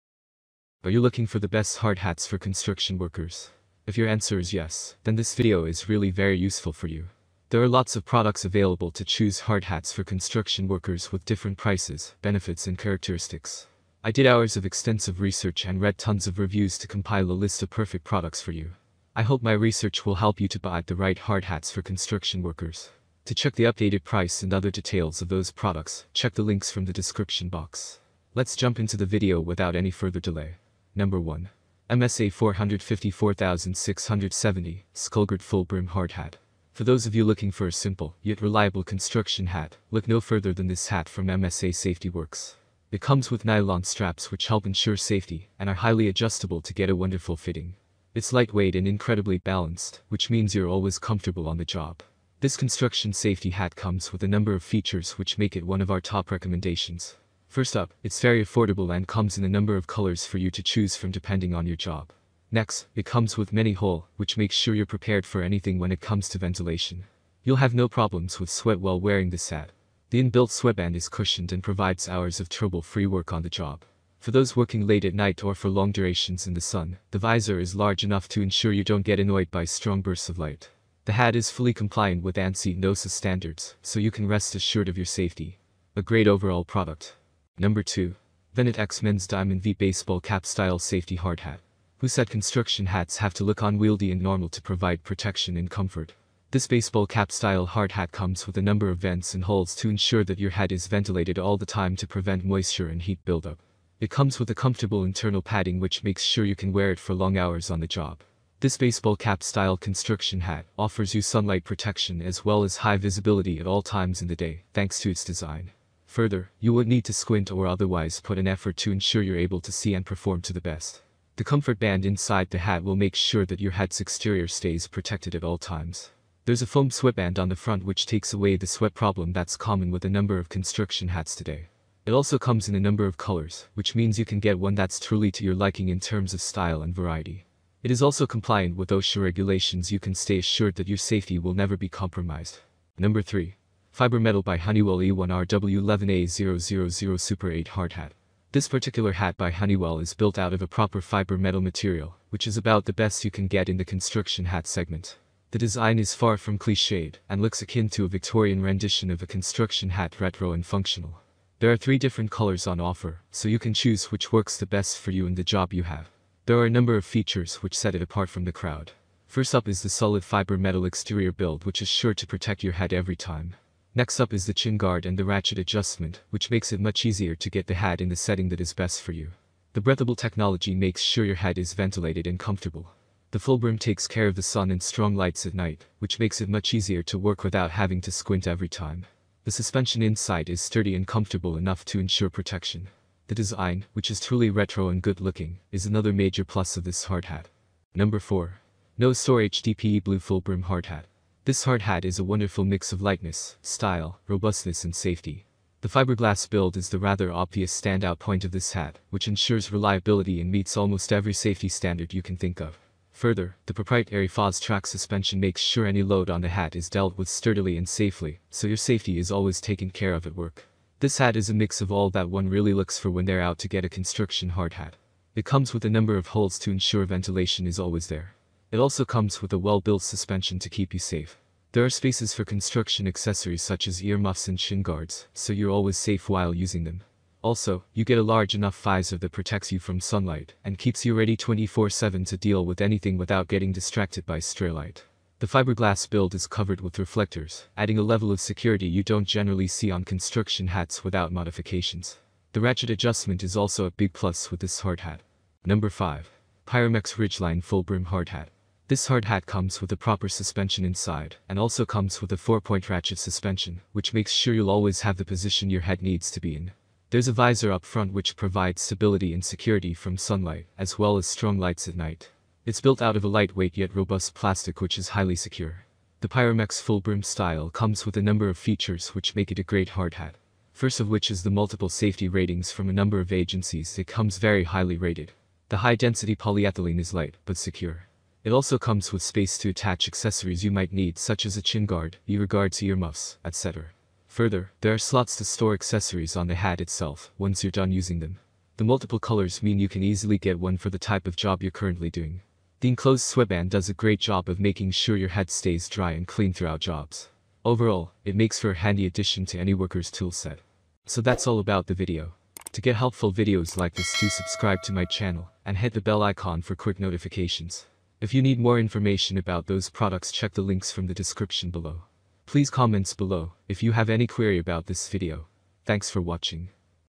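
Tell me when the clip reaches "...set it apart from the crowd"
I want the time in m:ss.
2:47.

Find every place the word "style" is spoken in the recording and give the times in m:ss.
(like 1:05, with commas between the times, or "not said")
1:30, 1:37, 1:49, 2:16, 3:23, 4:37.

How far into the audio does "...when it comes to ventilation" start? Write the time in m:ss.
1:05.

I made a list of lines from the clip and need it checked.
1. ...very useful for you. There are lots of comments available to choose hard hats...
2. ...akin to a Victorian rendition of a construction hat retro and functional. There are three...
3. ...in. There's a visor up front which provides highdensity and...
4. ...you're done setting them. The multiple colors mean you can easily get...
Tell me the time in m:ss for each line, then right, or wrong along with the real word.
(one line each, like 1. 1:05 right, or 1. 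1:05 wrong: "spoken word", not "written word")
1. 0:06 wrong: "products", not "comments"
2. 2:37 right
3. 4:26 wrong: "stability", not "highdensity"
4. 4:57 wrong: "using", not "setting".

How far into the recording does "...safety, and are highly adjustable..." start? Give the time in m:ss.
0:44.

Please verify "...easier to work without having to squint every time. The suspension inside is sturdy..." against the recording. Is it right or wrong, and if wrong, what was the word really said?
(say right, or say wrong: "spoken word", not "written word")
right.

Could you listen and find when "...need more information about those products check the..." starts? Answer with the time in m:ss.
5:18.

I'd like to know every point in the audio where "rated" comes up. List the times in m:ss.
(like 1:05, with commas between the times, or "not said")
4:44.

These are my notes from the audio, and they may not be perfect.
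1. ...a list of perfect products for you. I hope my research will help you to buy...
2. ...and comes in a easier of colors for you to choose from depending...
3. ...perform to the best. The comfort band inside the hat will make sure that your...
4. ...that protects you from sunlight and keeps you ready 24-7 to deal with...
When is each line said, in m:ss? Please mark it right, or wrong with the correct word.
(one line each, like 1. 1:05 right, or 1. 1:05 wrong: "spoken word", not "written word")
1. 0:17 right
2. 0:58 wrong: "number", not "easier"
3. 2:00 right
4. 3:59 right.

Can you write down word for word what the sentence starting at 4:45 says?
The high-density polyethylene is light, but secure.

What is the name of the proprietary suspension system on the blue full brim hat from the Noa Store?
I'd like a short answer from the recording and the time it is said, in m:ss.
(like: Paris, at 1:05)
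FOS track suspension, at 3:34.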